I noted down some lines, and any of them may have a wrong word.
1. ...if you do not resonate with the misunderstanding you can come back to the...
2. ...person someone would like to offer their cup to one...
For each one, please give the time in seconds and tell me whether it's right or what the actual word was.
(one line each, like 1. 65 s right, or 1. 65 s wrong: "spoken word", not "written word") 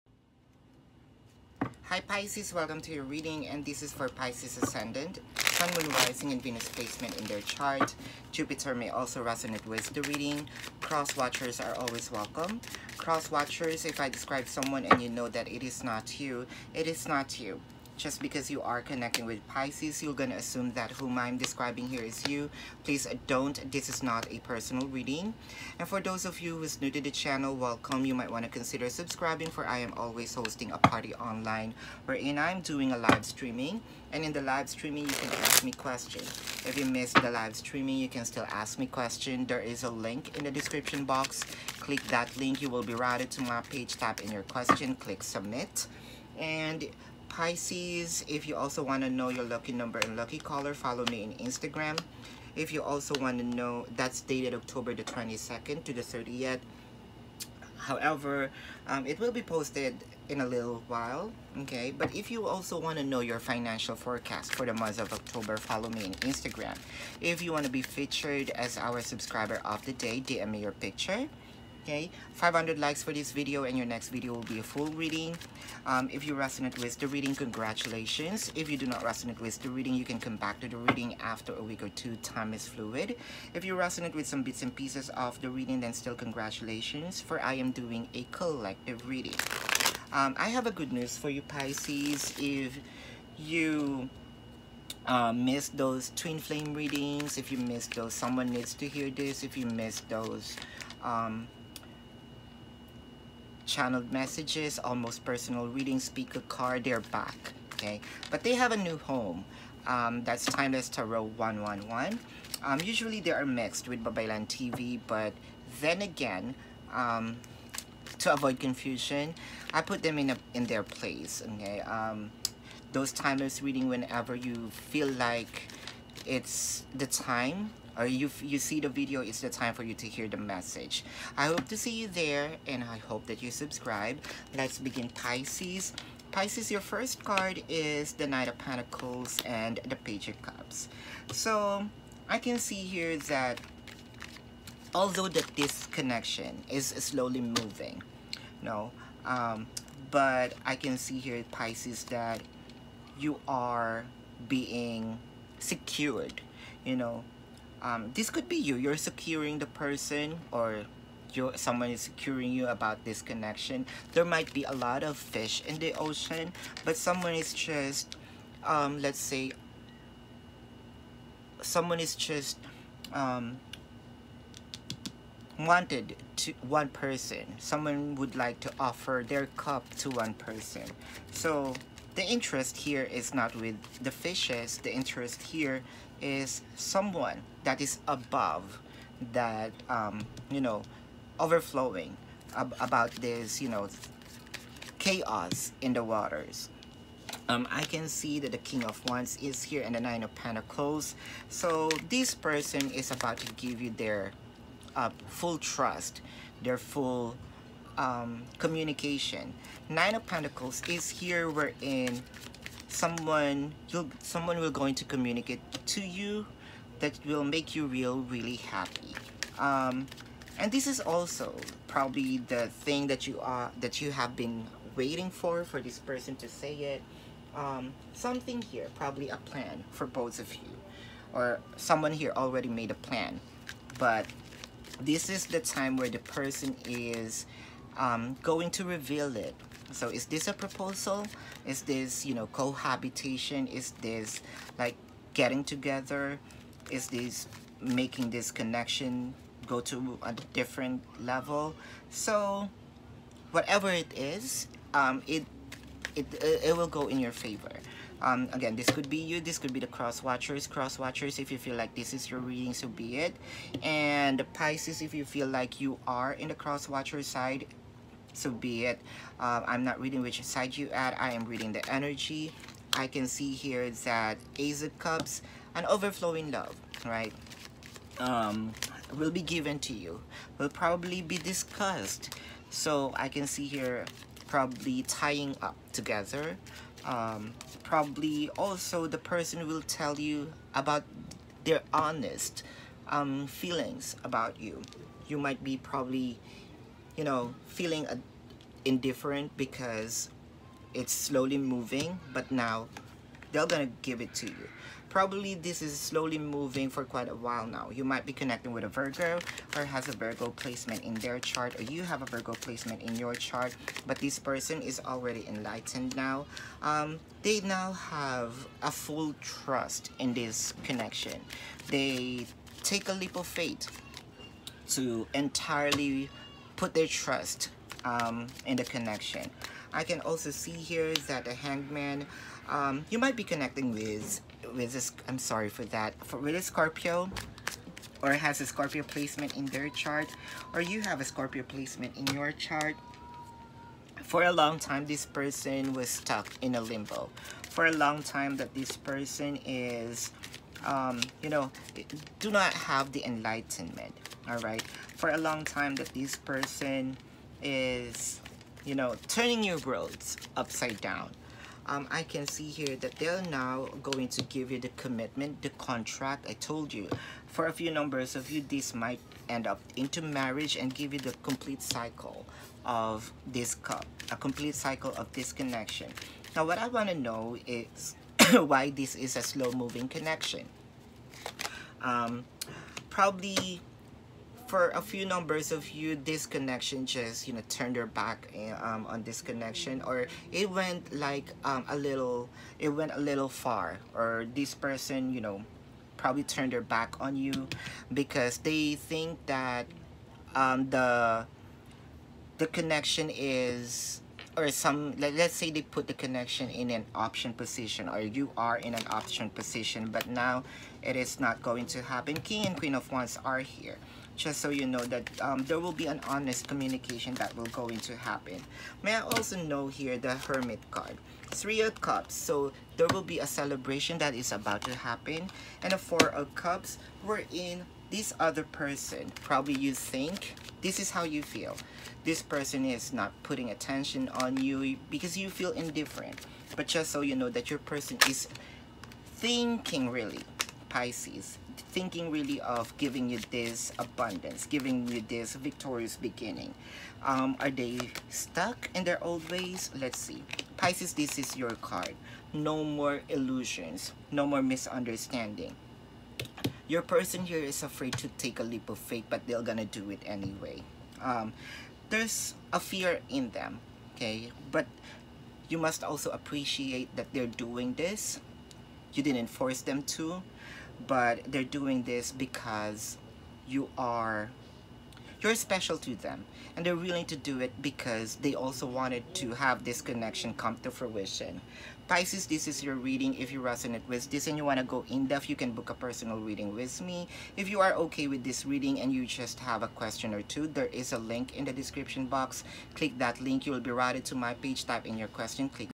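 1. 78 s wrong: "reading", not "misunderstanding"
2. 176 s right.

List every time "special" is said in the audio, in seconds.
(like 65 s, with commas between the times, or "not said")
475 s.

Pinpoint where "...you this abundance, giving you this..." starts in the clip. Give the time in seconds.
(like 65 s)
443 s.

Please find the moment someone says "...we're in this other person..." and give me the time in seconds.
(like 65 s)
427 s.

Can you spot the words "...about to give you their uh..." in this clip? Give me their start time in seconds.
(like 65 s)
203 s.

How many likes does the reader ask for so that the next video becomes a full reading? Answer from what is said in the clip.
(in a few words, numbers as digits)
500.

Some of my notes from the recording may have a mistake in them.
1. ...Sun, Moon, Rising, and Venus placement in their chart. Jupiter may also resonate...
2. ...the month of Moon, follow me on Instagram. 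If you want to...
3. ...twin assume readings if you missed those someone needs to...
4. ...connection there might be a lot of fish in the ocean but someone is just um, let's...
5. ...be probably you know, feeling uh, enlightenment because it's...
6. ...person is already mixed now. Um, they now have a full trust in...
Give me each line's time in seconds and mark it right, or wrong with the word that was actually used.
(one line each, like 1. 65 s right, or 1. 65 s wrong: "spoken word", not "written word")
1. 5 s right
2. 64 s wrong: "October", not "Moon"
3. 96 s wrong: "flame", not "assume"
4. 163 s right
5. 295 s wrong: "indifferent", not "enlightenment"
6. 314 s wrong: "enlightened", not "mixed".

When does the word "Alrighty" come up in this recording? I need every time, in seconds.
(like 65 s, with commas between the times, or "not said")
not said.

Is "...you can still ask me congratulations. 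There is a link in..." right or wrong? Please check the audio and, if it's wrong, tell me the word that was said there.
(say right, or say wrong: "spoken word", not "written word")
wrong: "questions", not "congratulations".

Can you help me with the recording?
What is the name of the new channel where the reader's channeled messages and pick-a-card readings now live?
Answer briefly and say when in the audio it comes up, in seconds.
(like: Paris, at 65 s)
Timeless Tarot 111, at 110 s.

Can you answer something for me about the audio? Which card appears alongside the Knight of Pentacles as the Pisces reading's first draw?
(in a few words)
Page of Cups.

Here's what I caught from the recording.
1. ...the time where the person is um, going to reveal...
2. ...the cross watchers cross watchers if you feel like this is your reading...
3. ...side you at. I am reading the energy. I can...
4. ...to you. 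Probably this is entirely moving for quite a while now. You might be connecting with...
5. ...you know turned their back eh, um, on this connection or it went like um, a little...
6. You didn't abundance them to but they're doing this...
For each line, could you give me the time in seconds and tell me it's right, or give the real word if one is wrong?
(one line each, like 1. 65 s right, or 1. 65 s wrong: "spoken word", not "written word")
1. 235 s right
2. 259 s right
3. 270 s right
4. 304 s wrong: "slowly", not "entirely"
5. 387 s right
6. 469 s wrong: "force", not "abundance".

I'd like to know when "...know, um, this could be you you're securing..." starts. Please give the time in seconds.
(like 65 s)
156 s.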